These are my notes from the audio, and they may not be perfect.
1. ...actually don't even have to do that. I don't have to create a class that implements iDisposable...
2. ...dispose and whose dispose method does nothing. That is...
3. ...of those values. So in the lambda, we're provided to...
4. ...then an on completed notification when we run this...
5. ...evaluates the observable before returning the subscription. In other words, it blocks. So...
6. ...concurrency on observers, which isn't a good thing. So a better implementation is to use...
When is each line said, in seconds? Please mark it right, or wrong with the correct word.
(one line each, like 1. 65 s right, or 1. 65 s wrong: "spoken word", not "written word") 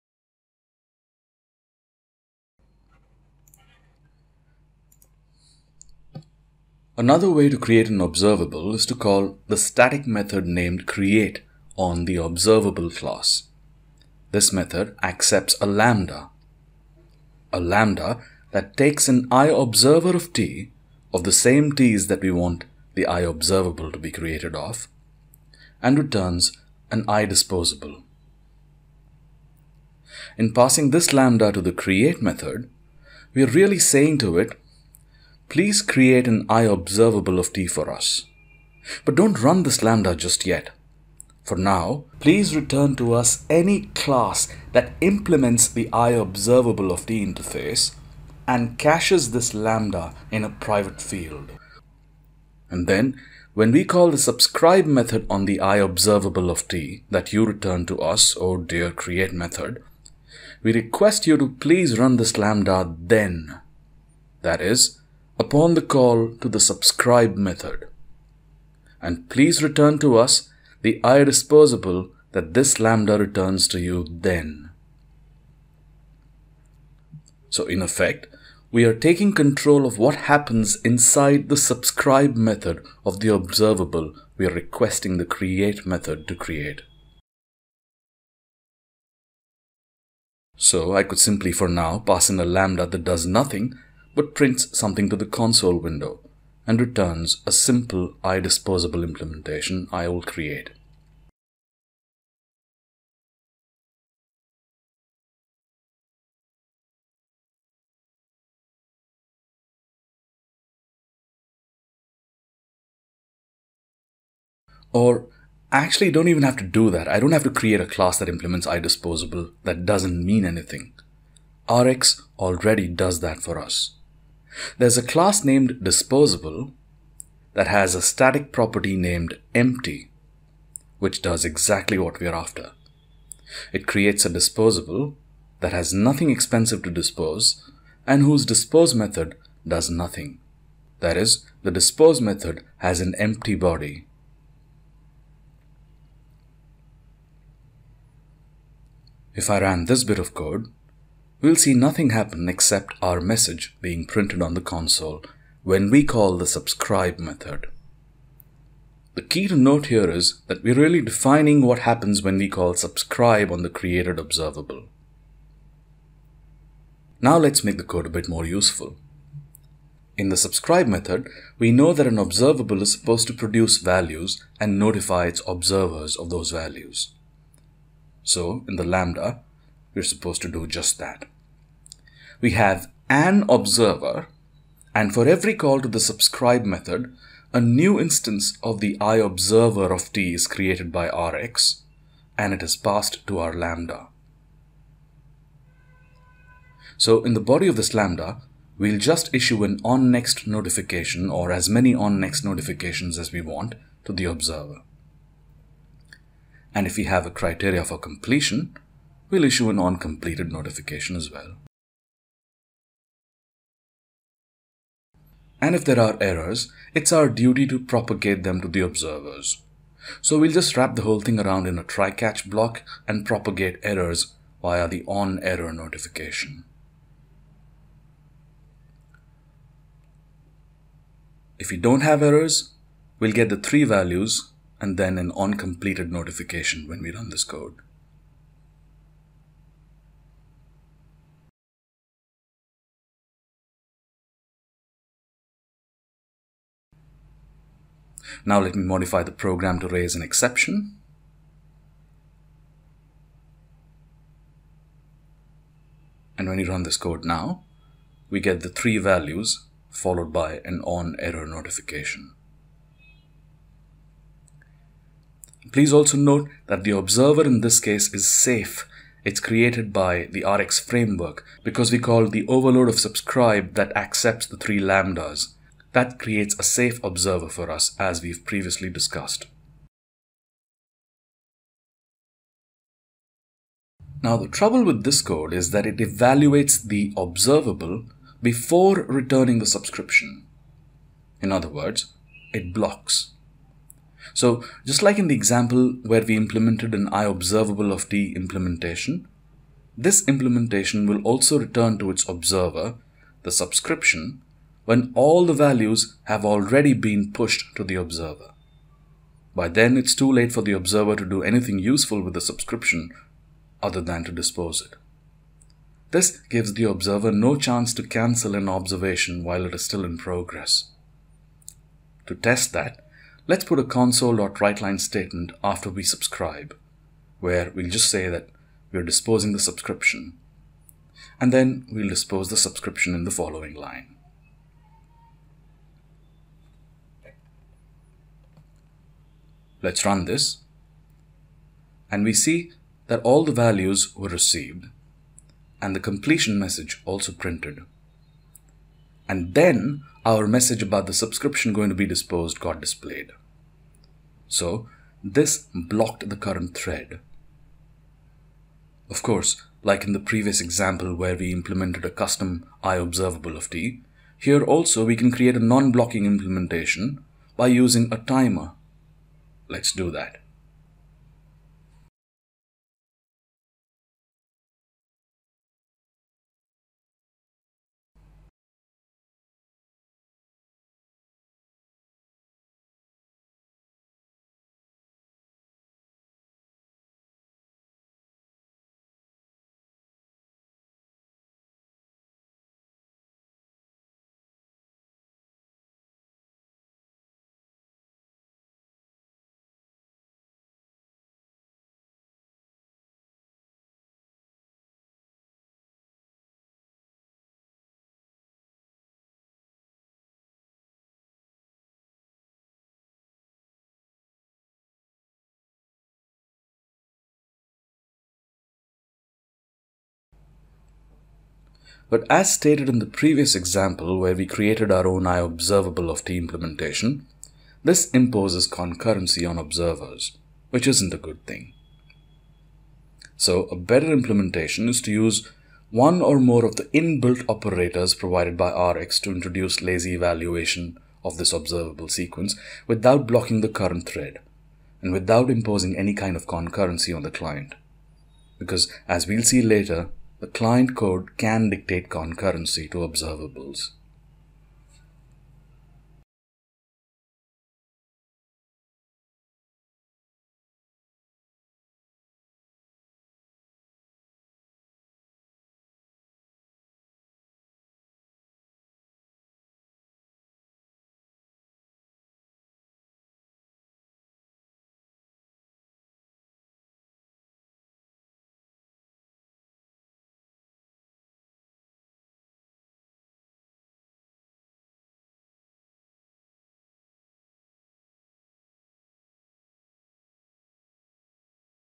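1. 115 s right
2. 136 s right
3. 176 s wrong: "supposed", not "provided"
4. 234 s right
5. 285 s right
6. 428 s right.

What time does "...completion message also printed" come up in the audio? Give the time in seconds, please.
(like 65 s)
345 s.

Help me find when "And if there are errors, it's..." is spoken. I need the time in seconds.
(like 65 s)
215 s.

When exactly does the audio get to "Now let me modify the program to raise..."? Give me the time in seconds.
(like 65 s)
248 s.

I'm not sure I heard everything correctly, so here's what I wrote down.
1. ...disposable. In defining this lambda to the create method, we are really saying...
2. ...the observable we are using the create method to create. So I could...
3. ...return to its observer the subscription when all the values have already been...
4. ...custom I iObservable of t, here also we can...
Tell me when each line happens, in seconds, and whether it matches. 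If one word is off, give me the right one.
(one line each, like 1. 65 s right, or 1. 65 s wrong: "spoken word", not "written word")
1. 27 s wrong: "passing", not "defining"
2. 83 s wrong: "requesting", not "using"
3. 301 s right
4. 362 s wrong: "observable", not "iObservable".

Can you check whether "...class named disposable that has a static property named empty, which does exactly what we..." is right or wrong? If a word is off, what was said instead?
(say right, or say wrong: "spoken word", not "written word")
right.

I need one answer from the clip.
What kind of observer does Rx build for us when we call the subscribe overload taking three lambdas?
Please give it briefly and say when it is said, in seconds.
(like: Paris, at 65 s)
a safe observer, at 276 s.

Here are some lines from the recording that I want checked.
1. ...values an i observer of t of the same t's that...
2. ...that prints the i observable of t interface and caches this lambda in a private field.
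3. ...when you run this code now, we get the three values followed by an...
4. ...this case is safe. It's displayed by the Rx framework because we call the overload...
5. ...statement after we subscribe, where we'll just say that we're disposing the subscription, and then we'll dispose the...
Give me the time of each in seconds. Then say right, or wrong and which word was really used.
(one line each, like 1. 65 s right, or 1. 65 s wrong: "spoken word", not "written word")
1. 18 s wrong: "takes", not "values"
2. 44 s wrong: "implements", not "prints"
3. 256 s right
4. 267 s wrong: "created", not "displayed"
5. 324 s right.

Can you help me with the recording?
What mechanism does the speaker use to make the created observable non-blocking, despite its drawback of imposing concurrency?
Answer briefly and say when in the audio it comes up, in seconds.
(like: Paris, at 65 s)
a timer, at 368 s.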